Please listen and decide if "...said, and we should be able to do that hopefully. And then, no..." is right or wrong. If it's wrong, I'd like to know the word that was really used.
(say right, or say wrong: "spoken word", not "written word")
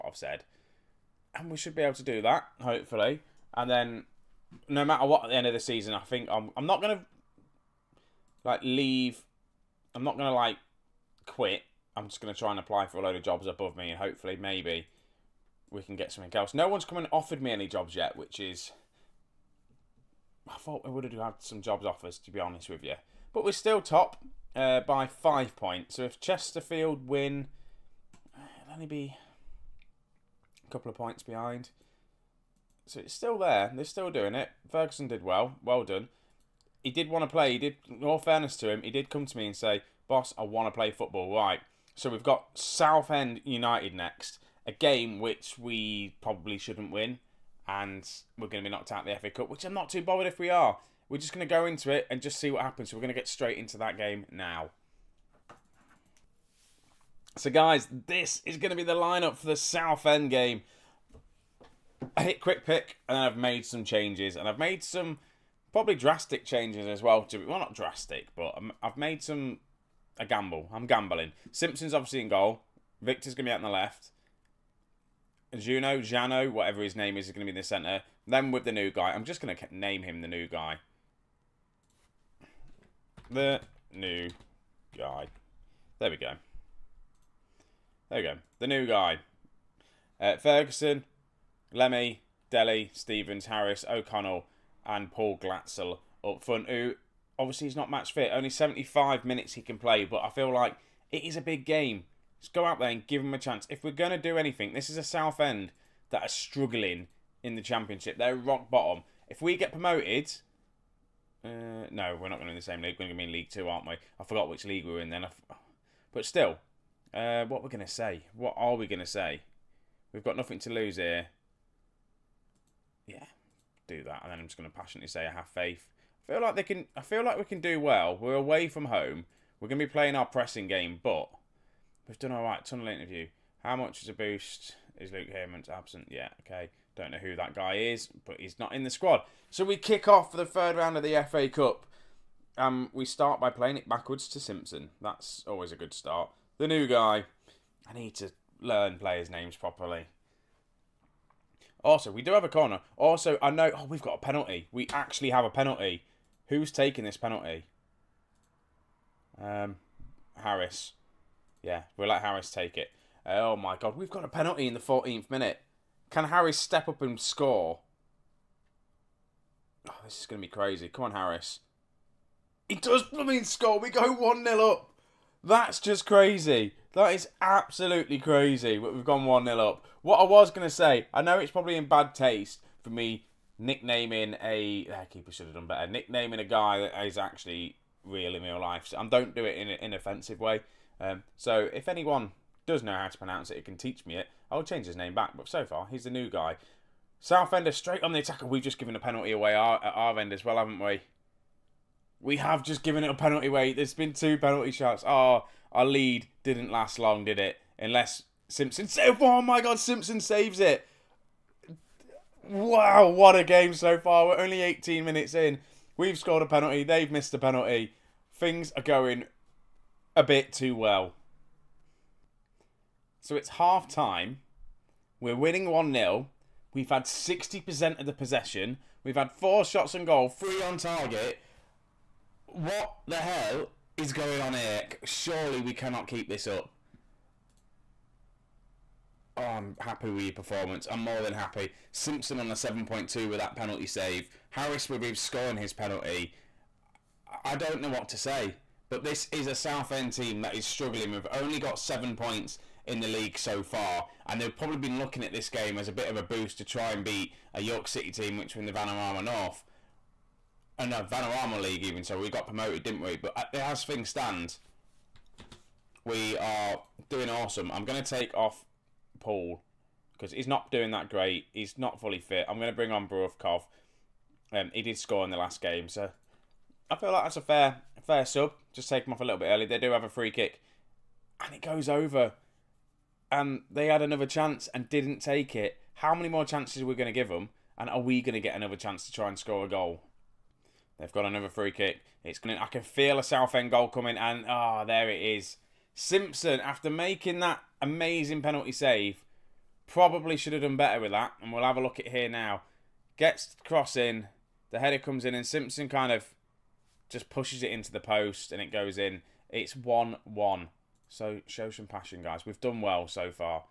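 right.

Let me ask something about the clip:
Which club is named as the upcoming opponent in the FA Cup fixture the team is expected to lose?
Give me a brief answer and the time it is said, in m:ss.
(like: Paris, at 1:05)
Southend United, at 0:42.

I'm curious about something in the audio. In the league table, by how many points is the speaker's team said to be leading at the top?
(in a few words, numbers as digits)
5.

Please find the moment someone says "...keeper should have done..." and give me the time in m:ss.
3:05.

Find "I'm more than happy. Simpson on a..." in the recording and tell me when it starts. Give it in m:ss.
4:00.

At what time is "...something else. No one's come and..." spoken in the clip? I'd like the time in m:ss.
0:16.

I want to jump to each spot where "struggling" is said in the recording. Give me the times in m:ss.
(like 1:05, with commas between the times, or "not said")
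1:46, 4:10.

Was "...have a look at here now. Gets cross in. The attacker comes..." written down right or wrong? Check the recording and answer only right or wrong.
wrong.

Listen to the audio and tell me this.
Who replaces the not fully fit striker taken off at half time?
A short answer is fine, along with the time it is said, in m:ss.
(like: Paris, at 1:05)
Burakov, at 4:33.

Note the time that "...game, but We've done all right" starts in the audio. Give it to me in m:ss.
2:10.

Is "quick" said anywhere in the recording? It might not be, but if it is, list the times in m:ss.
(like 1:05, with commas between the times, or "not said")
1:02.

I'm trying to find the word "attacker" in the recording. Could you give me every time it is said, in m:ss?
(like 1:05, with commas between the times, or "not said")
3:18.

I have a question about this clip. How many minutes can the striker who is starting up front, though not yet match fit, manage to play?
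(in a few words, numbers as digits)
75.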